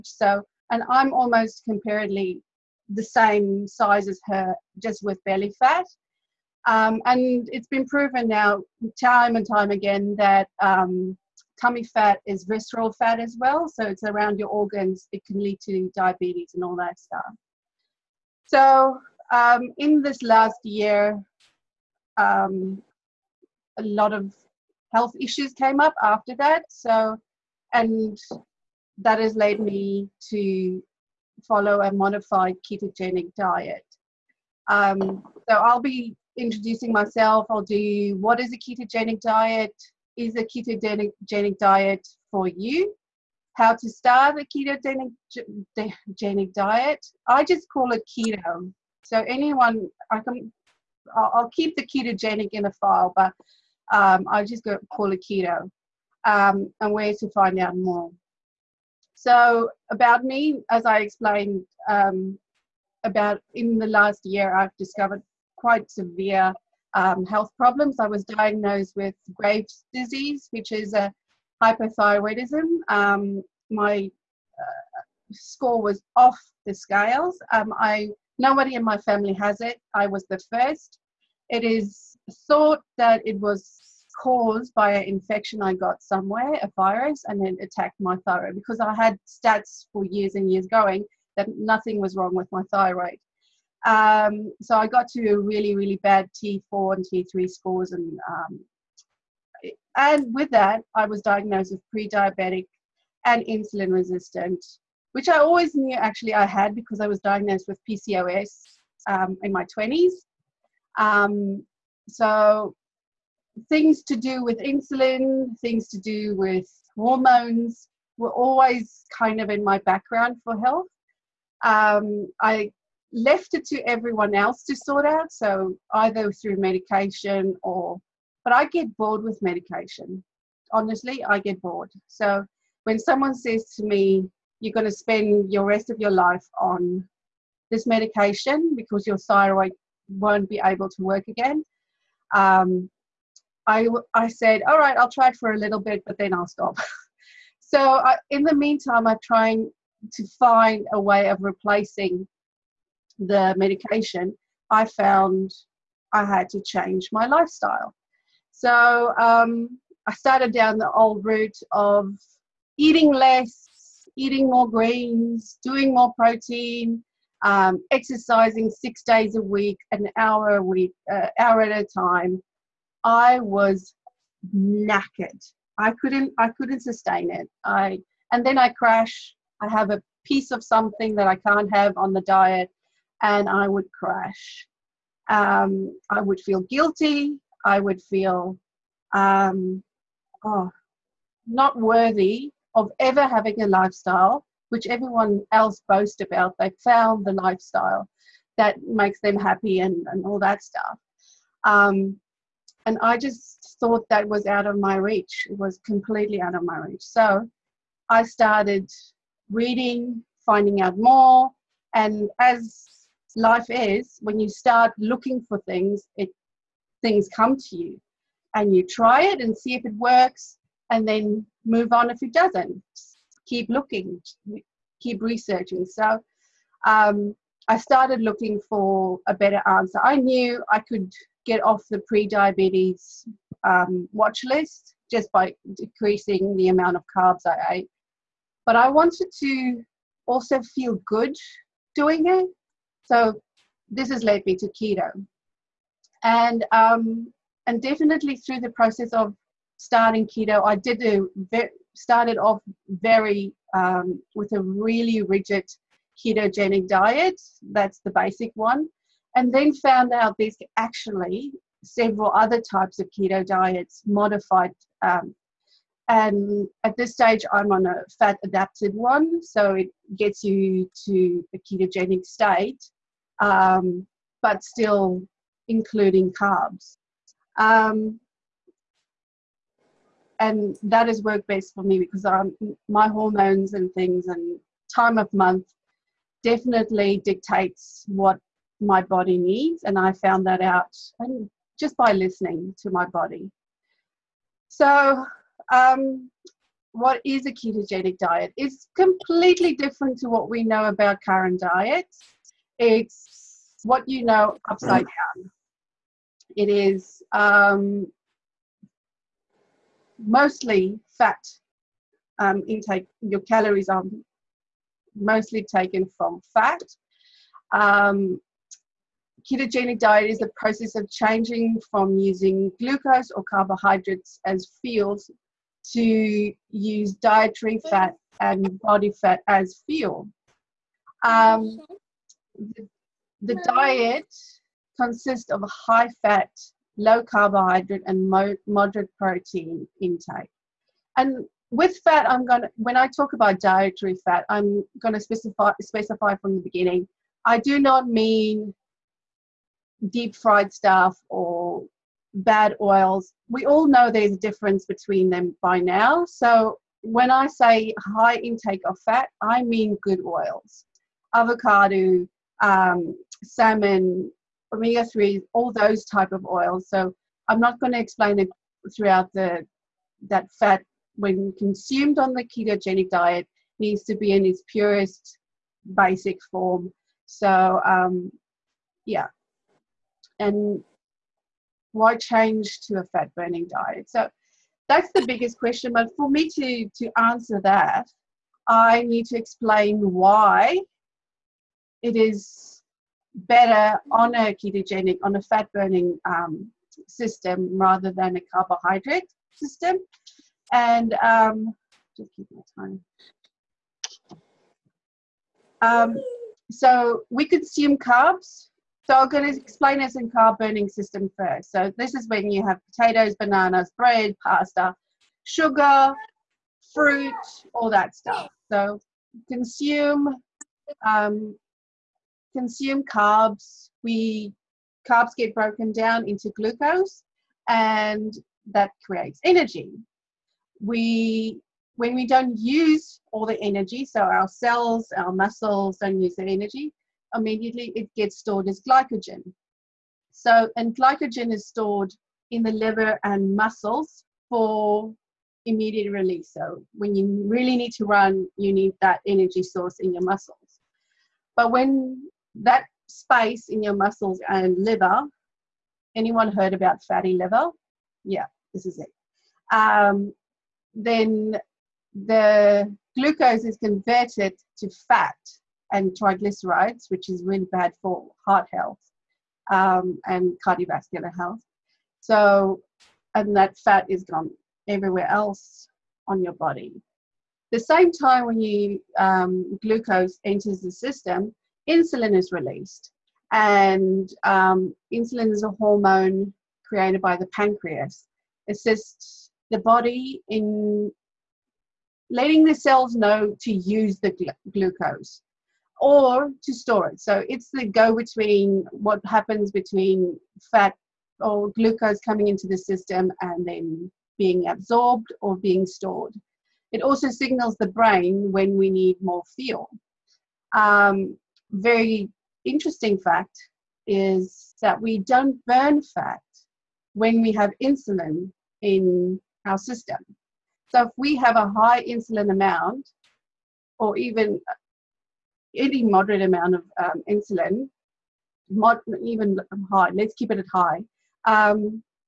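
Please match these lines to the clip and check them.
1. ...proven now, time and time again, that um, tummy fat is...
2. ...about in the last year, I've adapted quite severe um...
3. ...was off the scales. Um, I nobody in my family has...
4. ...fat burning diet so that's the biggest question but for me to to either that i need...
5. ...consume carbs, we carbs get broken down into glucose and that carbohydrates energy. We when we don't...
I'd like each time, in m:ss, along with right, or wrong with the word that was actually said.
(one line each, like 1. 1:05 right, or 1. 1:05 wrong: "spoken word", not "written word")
1. 0:07 right
2. 1:03 wrong: "discovered", not "adapted"
3. 1:15 right
4. 6:23 wrong: "answer", not "either"
5. 7:02 wrong: "creates", not "carbohydrates".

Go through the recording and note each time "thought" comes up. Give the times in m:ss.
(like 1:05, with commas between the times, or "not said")
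1:22, 3:23.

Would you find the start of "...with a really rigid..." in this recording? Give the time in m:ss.
4:14.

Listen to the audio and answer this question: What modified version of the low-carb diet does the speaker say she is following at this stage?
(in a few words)
fat adapted.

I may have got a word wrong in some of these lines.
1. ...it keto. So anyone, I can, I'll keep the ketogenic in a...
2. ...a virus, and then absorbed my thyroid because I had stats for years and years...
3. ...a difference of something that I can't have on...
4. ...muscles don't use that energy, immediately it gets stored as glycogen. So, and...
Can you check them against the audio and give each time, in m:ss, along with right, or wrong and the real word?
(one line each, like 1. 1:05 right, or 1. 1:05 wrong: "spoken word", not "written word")
1. 0:47 right
2. 1:26 wrong: "attacked", not "absorbed"
3. 2:59 wrong: "piece", not "difference"
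4. 7:15 right.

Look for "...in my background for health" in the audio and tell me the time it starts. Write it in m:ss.
1:59.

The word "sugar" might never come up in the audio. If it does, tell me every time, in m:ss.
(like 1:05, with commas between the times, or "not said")
6:55.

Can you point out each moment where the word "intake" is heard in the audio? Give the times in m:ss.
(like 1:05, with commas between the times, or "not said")
5:12, 5:40, 5:58.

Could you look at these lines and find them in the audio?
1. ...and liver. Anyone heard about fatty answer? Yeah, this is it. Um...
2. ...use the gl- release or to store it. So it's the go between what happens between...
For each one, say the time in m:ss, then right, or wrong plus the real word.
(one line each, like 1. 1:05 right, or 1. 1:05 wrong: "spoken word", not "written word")
1. 7:34 wrong: "liver", not "answer"
2. 8:13 wrong: "glucose", not "release".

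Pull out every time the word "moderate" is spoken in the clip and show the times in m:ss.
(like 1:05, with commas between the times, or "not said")
5:38, 8:46.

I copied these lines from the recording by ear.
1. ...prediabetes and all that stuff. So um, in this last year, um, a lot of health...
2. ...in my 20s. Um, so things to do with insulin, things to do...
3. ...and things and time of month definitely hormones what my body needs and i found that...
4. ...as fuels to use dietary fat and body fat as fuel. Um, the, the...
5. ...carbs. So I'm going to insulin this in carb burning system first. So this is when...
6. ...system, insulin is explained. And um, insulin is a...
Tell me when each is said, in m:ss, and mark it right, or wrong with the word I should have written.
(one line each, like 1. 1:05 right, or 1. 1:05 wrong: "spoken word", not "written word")
1. 0:15 wrong: "diabetes", not "prediabetes"
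2. 1:49 right
3. 4:43 wrong: "dictates", not "hormones"
4. 5:24 right
5. 6:47 wrong: "explain", not "insulin"
6. 8:00 wrong: "released", not "explained".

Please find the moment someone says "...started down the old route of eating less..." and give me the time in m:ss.
2:40.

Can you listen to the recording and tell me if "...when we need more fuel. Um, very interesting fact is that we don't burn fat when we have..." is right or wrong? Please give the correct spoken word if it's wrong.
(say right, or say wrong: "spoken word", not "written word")
right.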